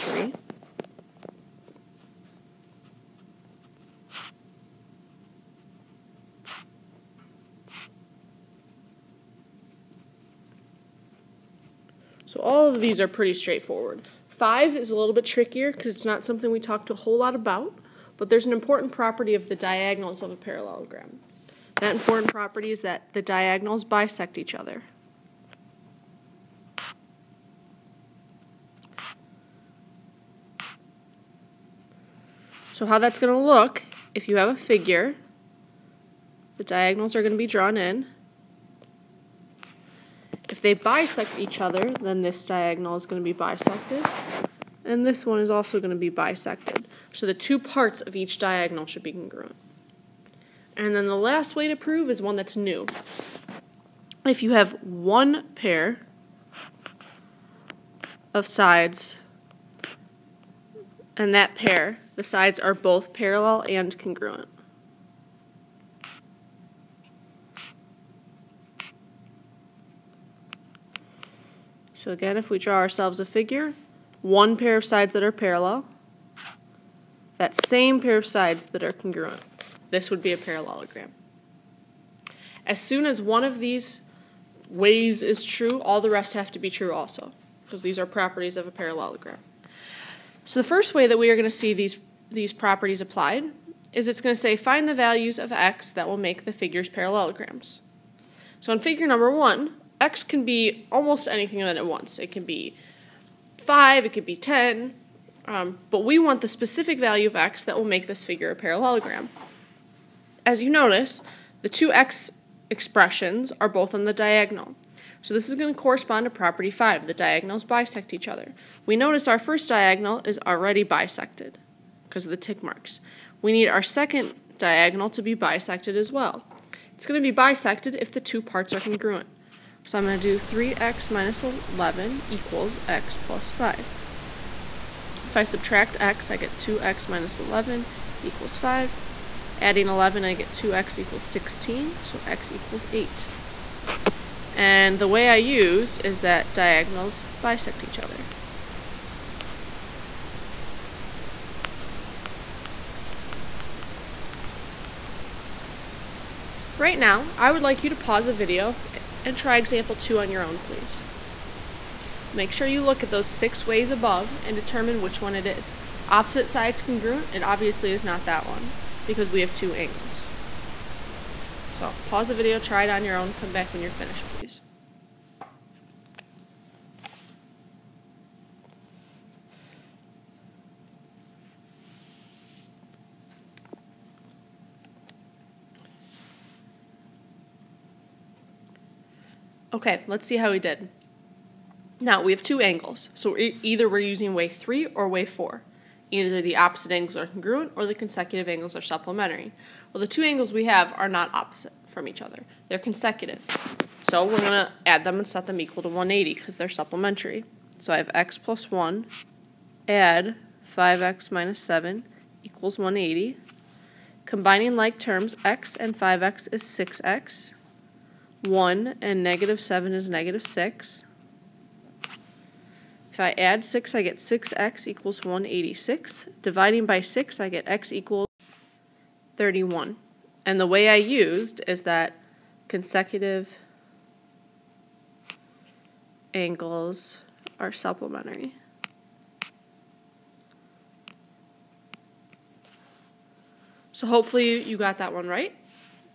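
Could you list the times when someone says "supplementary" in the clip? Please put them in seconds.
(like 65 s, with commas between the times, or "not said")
198 s, 206 s, 237 s.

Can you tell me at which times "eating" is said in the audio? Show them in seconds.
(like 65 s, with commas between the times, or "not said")
not said.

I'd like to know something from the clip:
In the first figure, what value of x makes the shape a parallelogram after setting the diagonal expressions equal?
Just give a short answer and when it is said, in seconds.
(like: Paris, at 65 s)
8, at 142 s.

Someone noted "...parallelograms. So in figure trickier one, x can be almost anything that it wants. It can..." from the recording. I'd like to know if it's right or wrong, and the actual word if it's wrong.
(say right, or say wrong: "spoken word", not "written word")
wrong: "number", not "trickier".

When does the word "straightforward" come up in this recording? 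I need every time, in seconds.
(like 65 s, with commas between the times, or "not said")
13 s.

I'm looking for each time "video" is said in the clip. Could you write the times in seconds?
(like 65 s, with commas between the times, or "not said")
158 s, 172 s.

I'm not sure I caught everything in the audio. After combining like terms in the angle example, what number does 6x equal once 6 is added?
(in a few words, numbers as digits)
186.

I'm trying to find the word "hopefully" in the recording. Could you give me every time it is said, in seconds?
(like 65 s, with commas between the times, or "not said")
244 s.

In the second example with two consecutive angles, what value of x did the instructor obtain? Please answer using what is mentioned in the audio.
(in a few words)
31.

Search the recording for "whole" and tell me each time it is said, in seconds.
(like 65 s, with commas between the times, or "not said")
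16 s.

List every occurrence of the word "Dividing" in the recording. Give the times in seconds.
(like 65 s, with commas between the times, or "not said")
226 s.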